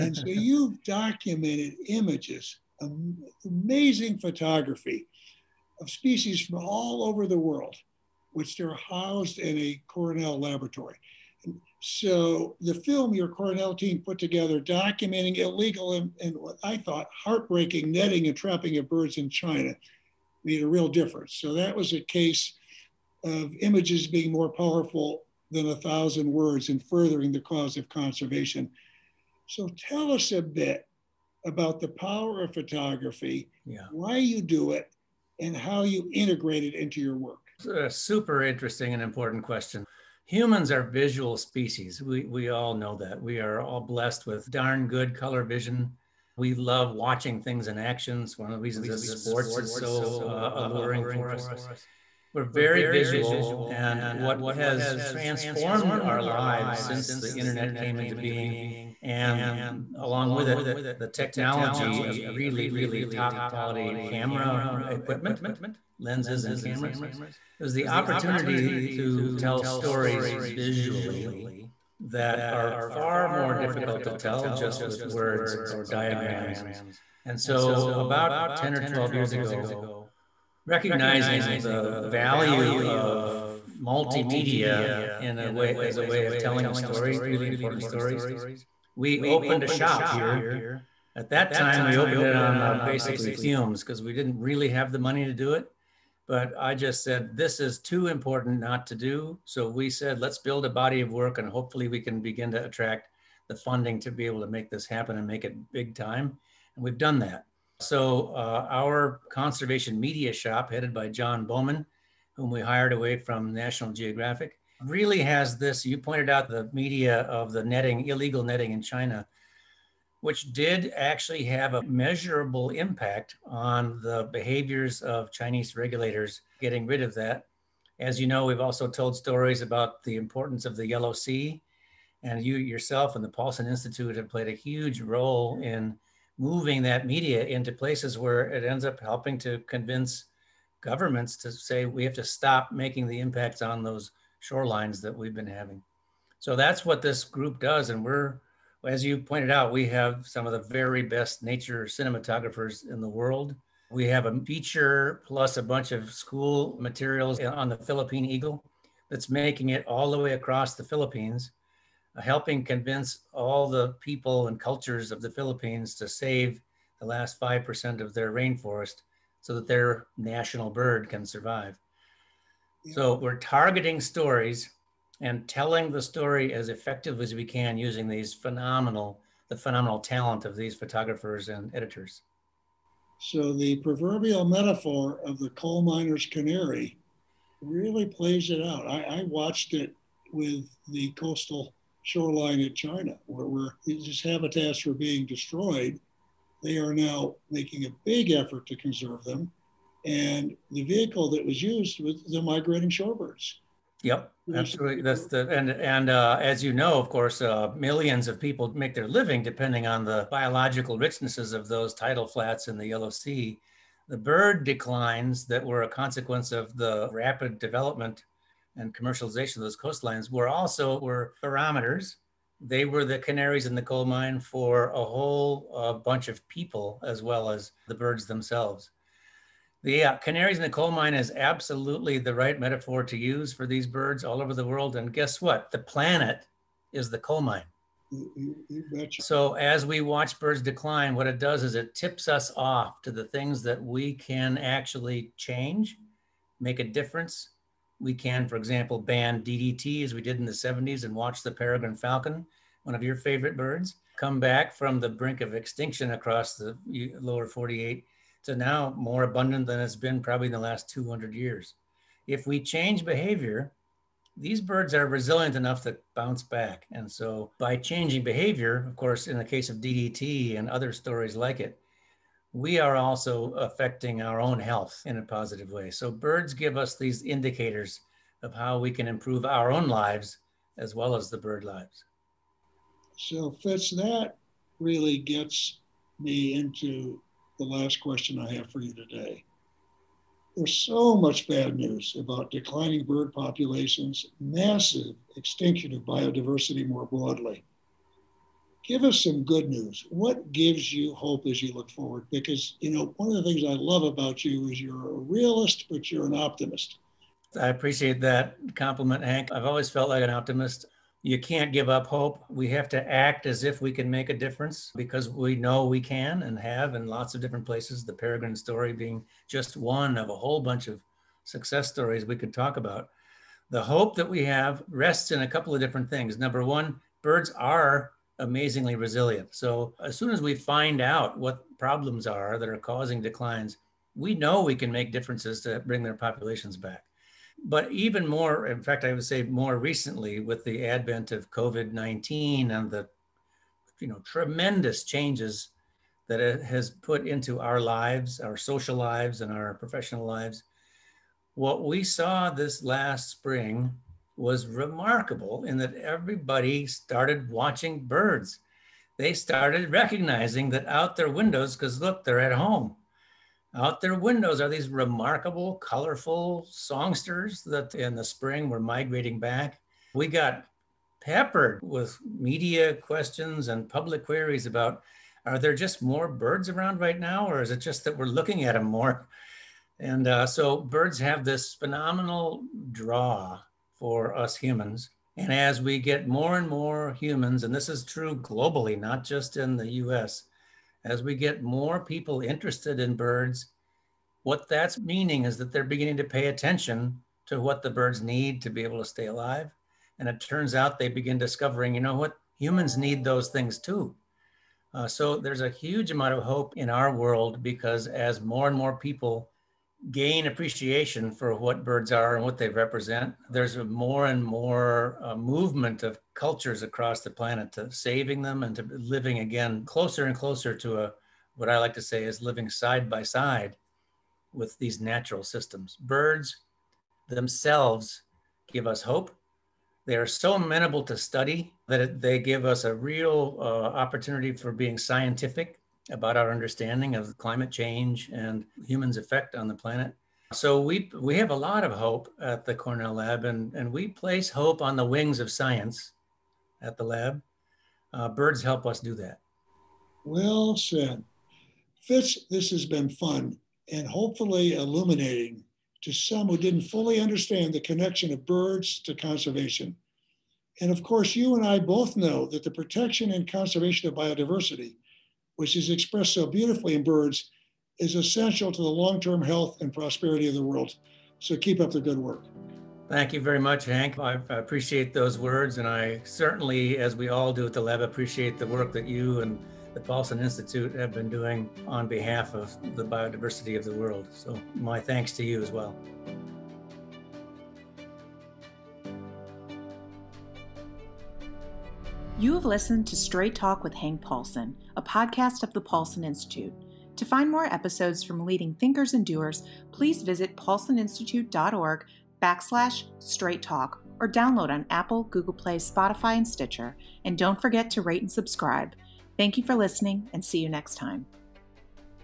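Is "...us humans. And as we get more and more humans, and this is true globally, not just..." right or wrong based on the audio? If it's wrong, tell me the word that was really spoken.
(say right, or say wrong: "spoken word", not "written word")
right.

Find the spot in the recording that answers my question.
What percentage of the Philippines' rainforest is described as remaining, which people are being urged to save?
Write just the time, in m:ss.
2:47.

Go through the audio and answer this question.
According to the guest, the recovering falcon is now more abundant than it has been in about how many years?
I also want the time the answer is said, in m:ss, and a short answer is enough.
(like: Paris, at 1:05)
200 years, at 4:20.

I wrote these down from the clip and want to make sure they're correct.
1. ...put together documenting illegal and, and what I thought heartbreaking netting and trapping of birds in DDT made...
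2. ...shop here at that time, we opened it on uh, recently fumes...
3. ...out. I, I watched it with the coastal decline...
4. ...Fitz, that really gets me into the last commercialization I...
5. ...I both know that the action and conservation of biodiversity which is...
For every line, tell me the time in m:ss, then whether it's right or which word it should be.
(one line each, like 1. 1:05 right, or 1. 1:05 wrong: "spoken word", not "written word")
1. 0:14 wrong: "China", not "DDT"
2. 1:29 wrong: "basically", not "recently"
3. 3:08 wrong: "shoreline", not "decline"
4. 4:43 wrong: "question", not "commercialization"
5. 7:41 wrong: "protection", not "action".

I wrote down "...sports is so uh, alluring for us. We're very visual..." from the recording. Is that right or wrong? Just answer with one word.
right.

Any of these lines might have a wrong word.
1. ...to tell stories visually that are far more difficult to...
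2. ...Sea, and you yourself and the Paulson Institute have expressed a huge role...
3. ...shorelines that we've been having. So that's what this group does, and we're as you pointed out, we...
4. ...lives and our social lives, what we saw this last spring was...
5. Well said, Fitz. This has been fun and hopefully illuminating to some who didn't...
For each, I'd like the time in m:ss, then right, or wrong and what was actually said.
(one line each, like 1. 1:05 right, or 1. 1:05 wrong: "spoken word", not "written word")
1. 1:08 right
2. 2:11 wrong: "played", not "expressed"
3. 2:24 right
4. 5:48 wrong: "professional", not "social"
5. 7:30 right.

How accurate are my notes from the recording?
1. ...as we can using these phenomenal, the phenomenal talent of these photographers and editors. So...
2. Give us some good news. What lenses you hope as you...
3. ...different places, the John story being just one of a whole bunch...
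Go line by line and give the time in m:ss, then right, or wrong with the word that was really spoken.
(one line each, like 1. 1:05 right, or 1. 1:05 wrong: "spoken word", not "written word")
1. 2:57 right
2. 4:58 wrong: "gives", not "lenses"
3. 5:17 wrong: "Peregrine", not "John".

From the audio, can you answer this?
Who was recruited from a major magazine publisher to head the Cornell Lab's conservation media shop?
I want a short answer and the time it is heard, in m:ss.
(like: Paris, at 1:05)
John Bowman, at 1:51.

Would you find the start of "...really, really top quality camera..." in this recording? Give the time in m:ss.
1:02.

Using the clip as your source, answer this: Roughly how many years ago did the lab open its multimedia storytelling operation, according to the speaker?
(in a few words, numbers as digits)
10 or 12 years.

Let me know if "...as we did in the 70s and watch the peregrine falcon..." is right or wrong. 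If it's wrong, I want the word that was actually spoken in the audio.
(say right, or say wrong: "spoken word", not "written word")
right.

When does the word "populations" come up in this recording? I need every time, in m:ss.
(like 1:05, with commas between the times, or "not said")
4:53, 5:36.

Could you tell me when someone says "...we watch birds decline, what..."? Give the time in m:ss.
3:59.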